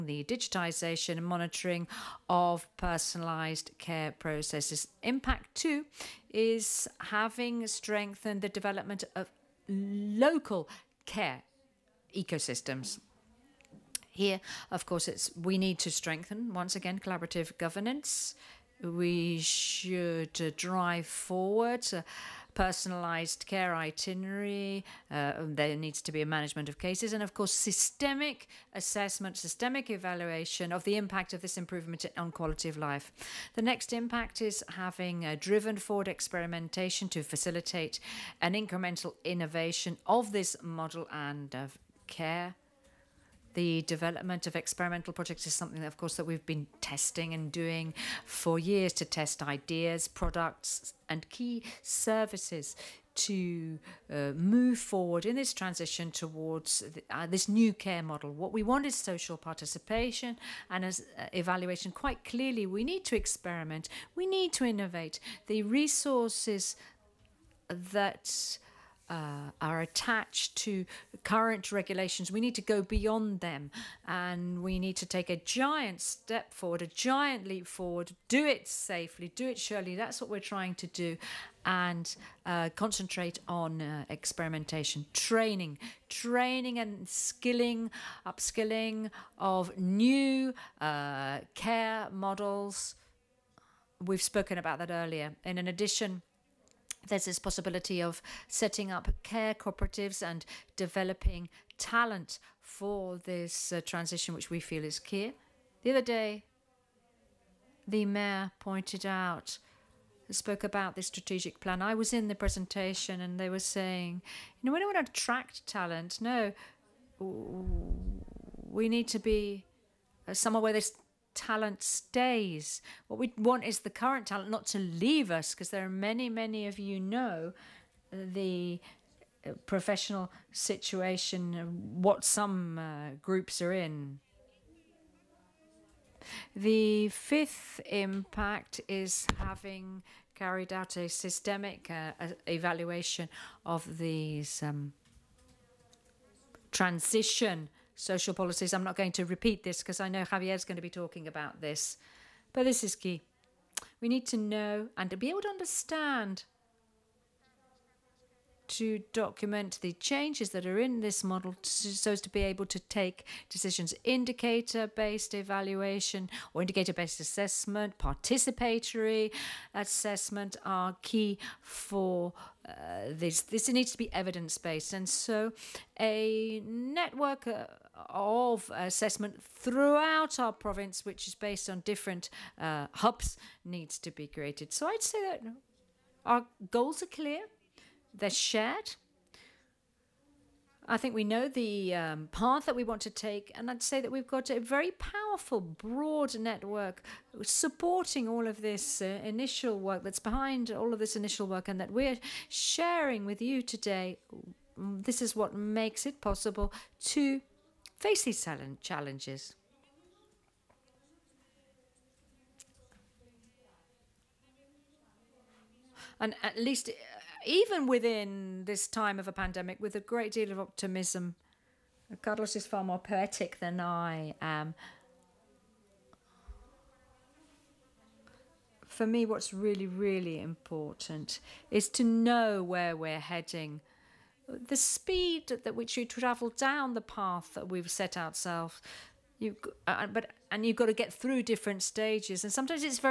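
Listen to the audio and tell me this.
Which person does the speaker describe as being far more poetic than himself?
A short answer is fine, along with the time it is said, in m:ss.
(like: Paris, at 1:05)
Carlos, at 3:42.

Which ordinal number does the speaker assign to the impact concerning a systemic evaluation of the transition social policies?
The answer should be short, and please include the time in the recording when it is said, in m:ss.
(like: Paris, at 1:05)
fifth, at 2:17.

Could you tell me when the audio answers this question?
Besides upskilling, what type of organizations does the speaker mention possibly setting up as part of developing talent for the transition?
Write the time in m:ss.
1:39.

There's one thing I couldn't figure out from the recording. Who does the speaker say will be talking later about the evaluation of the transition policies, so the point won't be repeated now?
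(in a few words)
Javier.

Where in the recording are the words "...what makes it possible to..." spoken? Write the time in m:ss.
3:25.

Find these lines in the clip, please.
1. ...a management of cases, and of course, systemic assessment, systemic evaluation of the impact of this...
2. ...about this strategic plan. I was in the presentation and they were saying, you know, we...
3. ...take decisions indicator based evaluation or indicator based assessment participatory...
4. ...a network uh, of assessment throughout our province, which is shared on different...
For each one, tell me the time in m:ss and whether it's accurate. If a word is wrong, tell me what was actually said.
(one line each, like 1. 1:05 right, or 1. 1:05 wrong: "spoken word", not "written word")
1. 0:26 right
2. 1:50 right
3. 2:42 right
4. 2:55 wrong: "based", not "shared".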